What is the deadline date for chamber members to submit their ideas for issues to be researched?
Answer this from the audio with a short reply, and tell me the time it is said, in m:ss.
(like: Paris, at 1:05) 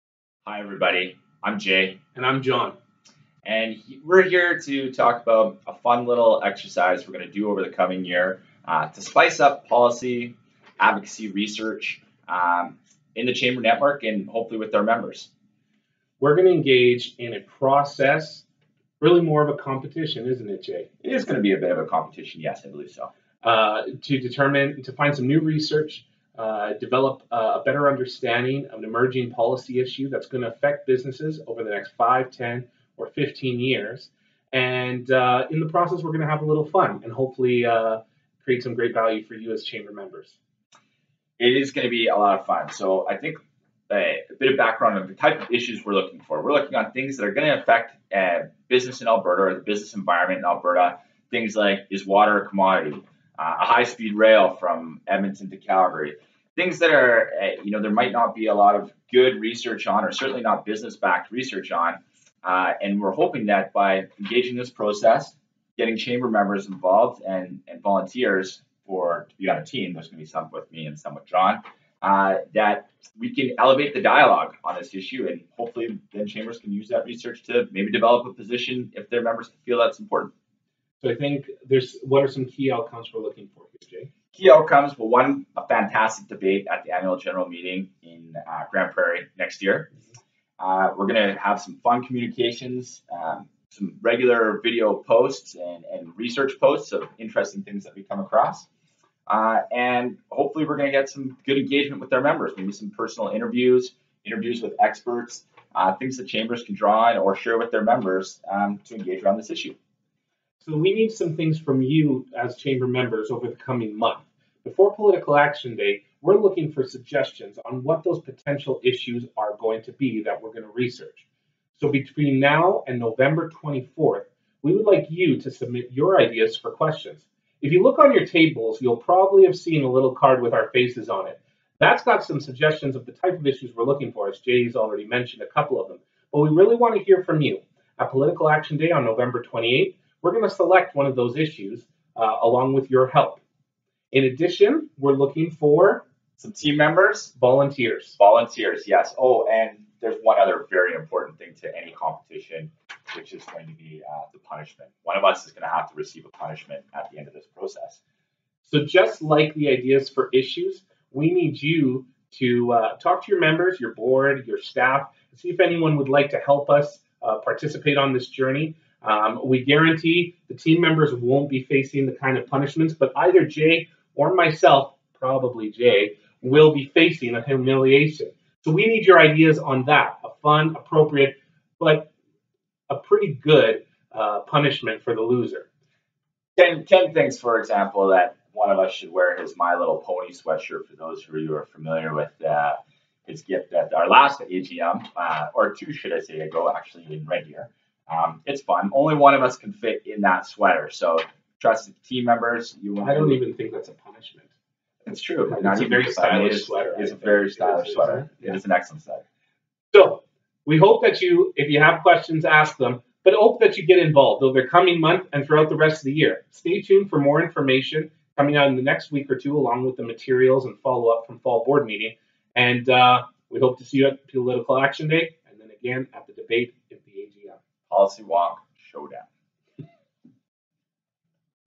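November 24th, at 2:02.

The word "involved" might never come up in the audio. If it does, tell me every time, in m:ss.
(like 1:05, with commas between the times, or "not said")
1:06, 3:33.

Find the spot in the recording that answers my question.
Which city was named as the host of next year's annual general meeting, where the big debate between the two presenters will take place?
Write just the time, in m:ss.
1:28.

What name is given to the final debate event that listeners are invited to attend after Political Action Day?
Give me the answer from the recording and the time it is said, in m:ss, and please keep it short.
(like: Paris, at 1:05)
Policy Wonk Showdown, at 3:47.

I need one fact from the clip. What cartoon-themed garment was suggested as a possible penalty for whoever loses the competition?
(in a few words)
My Little Pony sweatshirt.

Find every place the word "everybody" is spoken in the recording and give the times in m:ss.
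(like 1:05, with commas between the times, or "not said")
0:00.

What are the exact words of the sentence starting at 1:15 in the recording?
And hopefully, then chambers can use that research to maybe develop a position if their members feel that's important.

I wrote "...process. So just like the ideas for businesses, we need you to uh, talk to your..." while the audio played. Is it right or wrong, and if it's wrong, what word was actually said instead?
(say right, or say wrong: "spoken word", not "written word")
wrong: "issues", not "businesses".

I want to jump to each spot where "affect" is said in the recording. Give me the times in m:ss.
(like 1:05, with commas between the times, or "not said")
0:30, 0:47.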